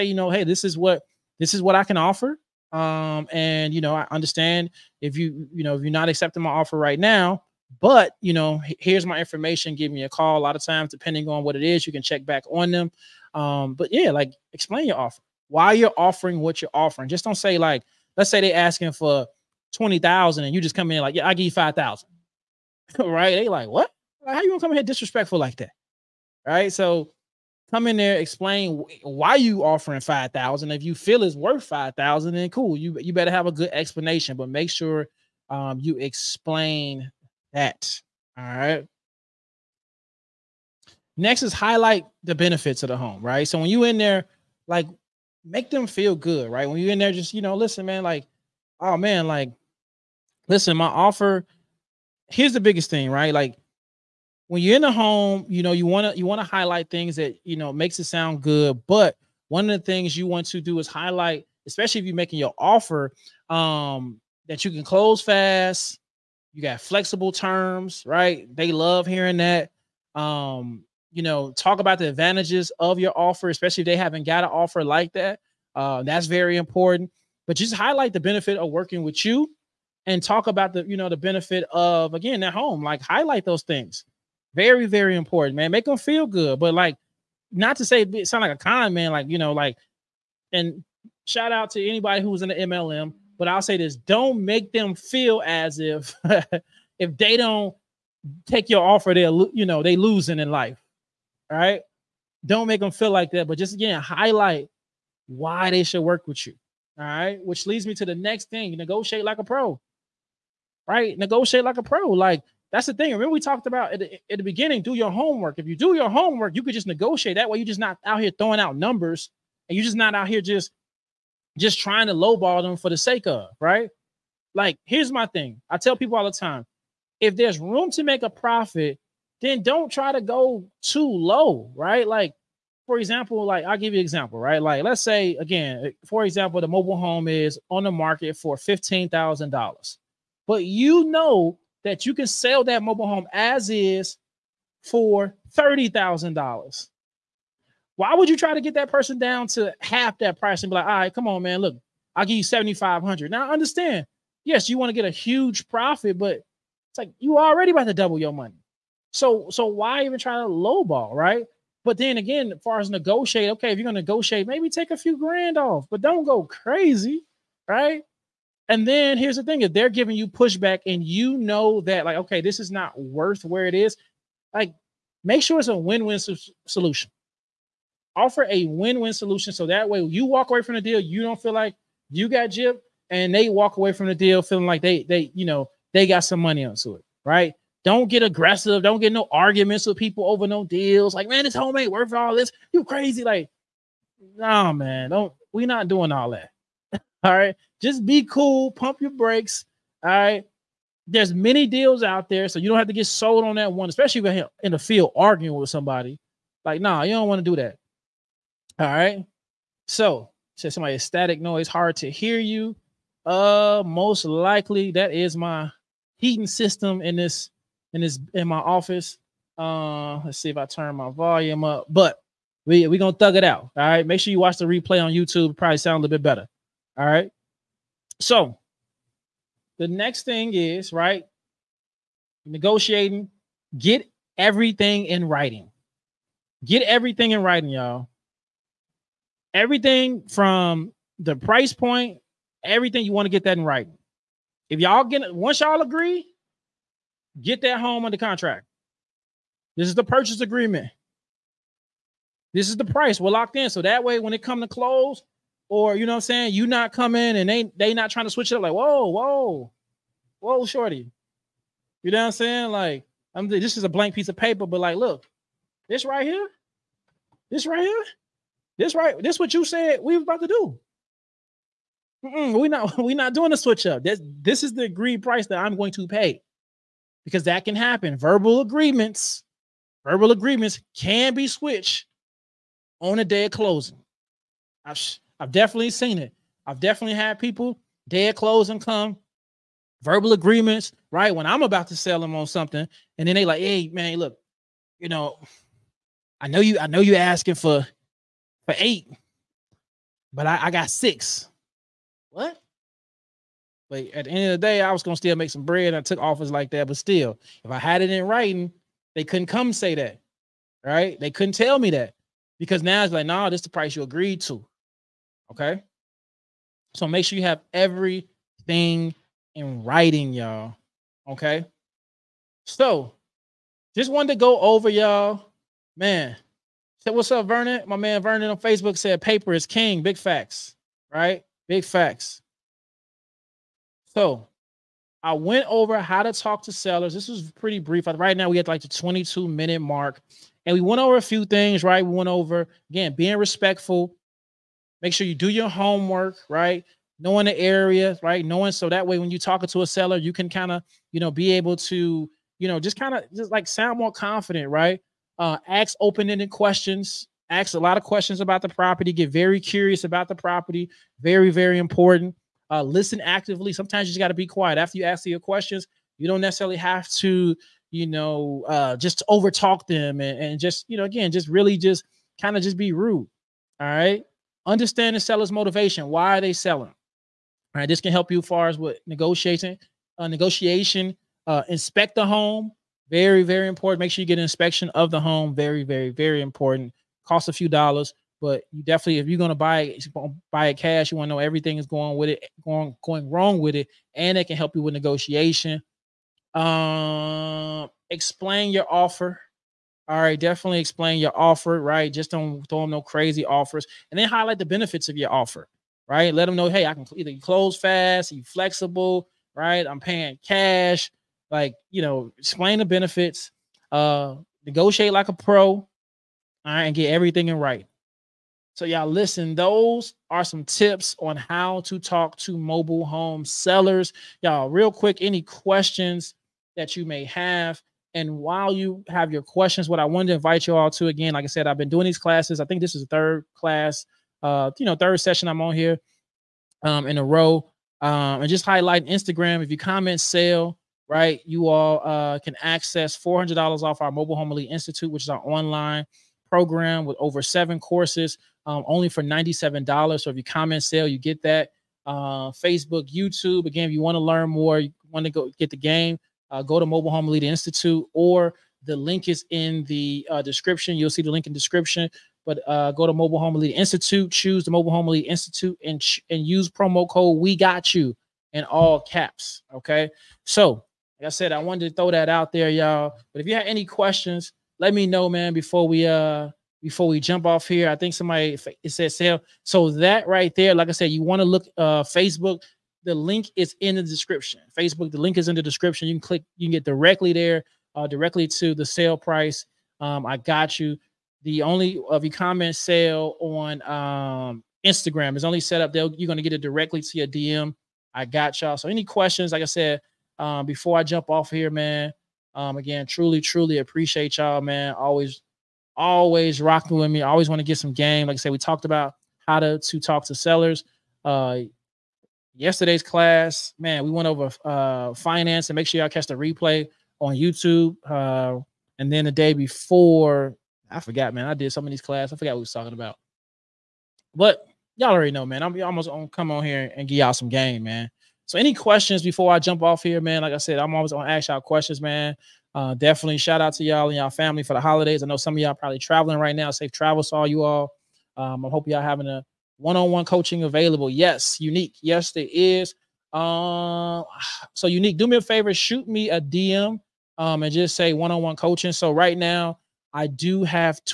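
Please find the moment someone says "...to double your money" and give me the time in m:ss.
2:37.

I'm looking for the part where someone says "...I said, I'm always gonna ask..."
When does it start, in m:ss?
8:50.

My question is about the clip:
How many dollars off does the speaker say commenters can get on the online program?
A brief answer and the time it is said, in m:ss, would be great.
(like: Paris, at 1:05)
$400, at 7:23.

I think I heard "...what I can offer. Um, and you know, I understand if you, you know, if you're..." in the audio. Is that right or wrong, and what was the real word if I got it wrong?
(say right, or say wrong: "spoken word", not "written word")
right.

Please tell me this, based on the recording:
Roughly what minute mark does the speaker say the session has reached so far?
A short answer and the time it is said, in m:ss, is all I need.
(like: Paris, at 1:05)
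22 minutes, at 5:38.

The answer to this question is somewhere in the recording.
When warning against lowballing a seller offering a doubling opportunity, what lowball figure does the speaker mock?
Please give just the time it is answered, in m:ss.
2:32.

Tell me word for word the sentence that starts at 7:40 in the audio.
You'll see the link in description.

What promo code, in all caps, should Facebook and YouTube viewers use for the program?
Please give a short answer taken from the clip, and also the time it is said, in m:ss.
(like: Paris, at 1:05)
WE GOT YOU, at 7:47.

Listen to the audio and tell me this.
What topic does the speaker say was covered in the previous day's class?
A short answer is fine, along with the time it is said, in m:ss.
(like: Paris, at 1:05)
finance, at 8:35.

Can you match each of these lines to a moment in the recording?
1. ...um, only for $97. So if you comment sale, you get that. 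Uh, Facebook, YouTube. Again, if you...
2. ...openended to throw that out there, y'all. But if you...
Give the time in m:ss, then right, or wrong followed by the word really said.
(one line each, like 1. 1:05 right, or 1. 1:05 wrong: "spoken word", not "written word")
1. 7:28 right
2. 7:51 wrong: "wanted", not "openended".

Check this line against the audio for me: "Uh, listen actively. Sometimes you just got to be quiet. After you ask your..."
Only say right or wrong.
right.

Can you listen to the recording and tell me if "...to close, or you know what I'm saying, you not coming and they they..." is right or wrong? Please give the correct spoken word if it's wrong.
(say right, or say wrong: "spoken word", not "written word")
right.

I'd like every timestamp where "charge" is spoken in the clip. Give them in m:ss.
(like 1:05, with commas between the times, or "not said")
not said.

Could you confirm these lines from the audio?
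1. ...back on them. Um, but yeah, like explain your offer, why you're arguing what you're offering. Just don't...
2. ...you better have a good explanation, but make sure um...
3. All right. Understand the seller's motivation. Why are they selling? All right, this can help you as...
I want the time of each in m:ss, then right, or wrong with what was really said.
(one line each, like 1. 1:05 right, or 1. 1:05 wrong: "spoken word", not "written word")
1. 0:12 wrong: "offering", not "arguing"
2. 0:32 right
3. 6:13 right.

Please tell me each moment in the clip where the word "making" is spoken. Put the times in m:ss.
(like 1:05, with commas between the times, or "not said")
1:02.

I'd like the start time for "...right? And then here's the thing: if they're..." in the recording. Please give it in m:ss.
2:47.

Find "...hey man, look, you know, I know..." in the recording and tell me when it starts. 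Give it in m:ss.
4:53.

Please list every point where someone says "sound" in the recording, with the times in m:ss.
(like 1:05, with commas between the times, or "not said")
0:58, 1:28, 3:45, 5:53.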